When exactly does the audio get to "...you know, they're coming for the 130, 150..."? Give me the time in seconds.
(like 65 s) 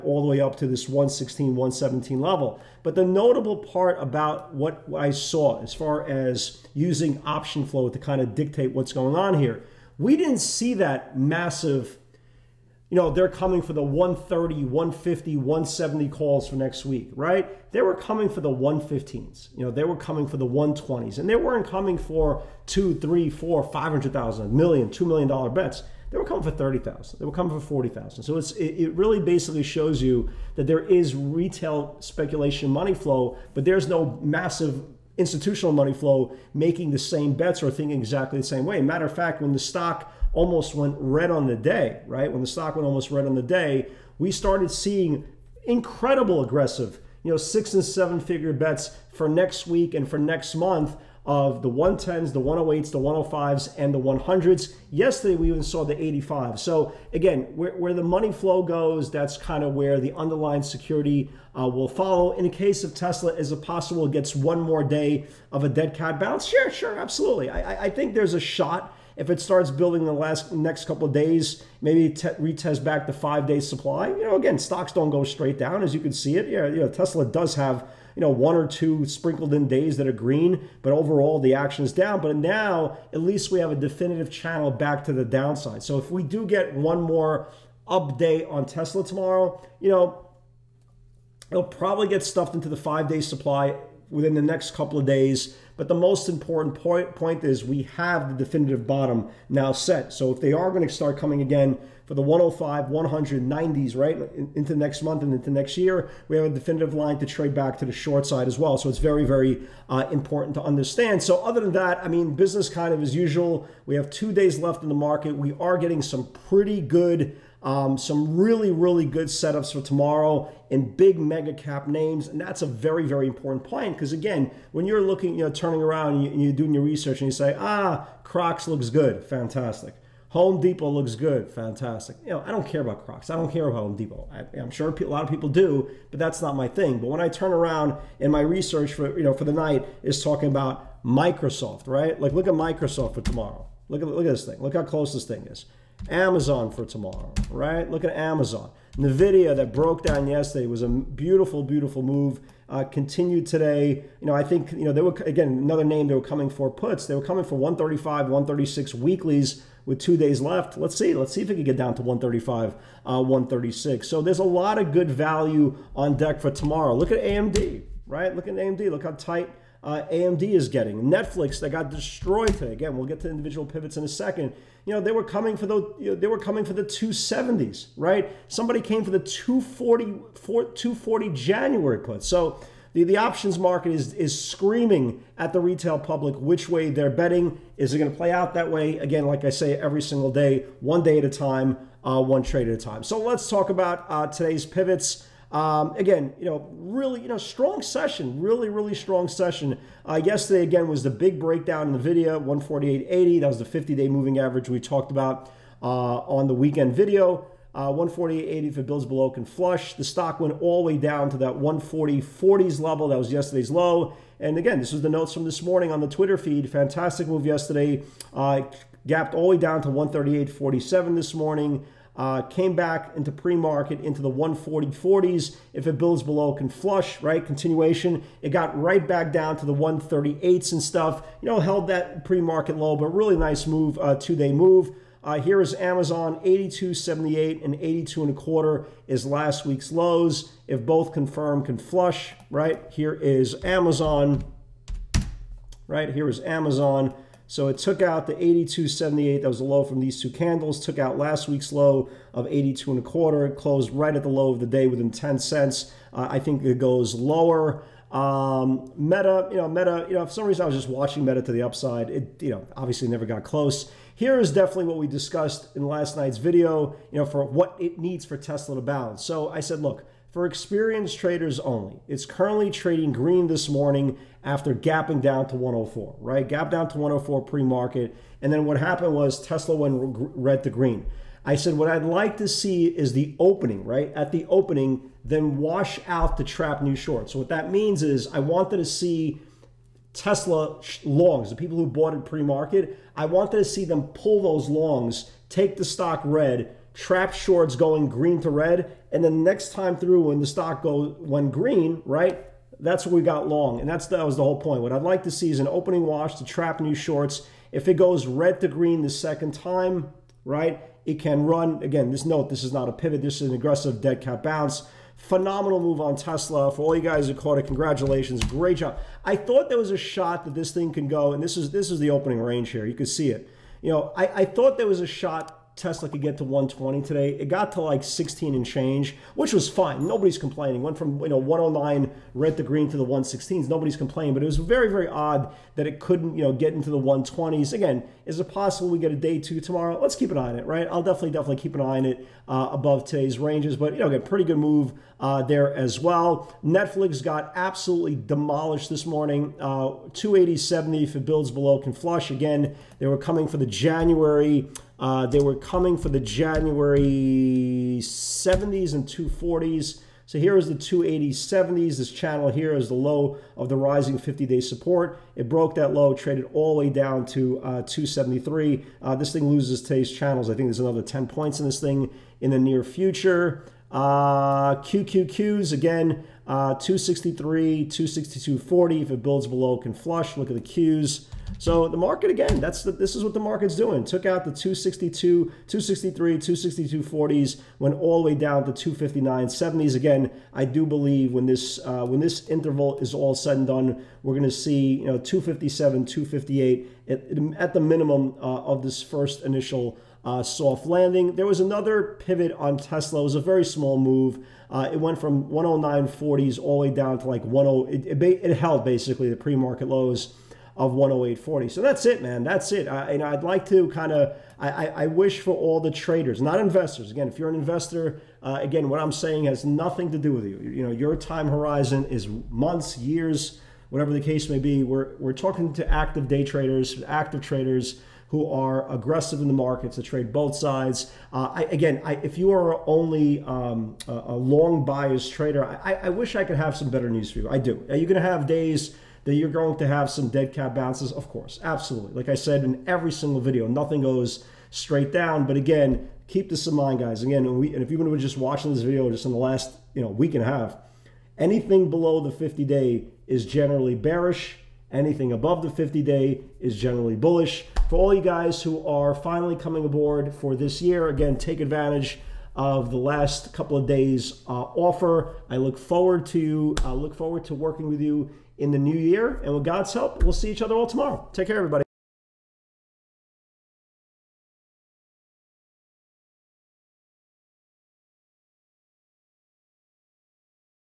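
12 s.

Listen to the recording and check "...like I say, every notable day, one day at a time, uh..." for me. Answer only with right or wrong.
wrong.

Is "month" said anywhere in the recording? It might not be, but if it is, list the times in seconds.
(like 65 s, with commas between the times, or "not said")
50 s, 105 s, 422 s.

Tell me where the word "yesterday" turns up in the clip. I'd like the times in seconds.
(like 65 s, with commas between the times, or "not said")
54 s, 150 s, 200 s, 213 s, 217 s.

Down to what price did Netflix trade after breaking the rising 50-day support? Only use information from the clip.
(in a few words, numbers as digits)
273.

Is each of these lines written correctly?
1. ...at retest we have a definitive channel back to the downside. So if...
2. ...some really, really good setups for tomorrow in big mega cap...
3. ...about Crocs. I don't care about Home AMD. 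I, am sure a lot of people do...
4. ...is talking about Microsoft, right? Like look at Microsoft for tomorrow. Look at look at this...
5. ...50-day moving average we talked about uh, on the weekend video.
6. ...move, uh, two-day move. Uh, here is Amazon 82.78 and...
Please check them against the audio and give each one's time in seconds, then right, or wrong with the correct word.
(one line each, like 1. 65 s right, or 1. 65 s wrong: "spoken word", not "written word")
1. 83 s wrong: "least", not "retest"
2. 117 s right
3. 132 s wrong: "Depot", not "AMD"
4. 140 s right
5. 203 s right
6. 233 s right.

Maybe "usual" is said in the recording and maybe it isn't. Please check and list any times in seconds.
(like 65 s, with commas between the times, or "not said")
113 s.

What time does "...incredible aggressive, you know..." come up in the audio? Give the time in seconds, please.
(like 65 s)
45 s.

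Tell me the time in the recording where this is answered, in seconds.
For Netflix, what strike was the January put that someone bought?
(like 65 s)
180 s.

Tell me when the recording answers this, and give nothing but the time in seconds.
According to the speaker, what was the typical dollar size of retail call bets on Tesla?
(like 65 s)
26 s.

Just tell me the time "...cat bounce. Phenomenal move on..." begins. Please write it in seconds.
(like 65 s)
314 s.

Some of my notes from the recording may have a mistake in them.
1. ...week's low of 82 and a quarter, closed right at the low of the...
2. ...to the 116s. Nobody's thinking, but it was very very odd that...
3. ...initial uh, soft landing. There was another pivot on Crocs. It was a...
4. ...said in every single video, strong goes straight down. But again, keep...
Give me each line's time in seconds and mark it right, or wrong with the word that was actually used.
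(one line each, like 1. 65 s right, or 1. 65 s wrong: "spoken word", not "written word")
1. 251 s right
2. 332 s wrong: "complaining", not "thinking"
3. 399 s wrong: "Tesla", not "Crocs"
4. 442 s wrong: "nothing", not "strong".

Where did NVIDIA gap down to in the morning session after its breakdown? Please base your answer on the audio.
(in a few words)
138.47.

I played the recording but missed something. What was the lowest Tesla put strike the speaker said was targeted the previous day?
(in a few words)
85.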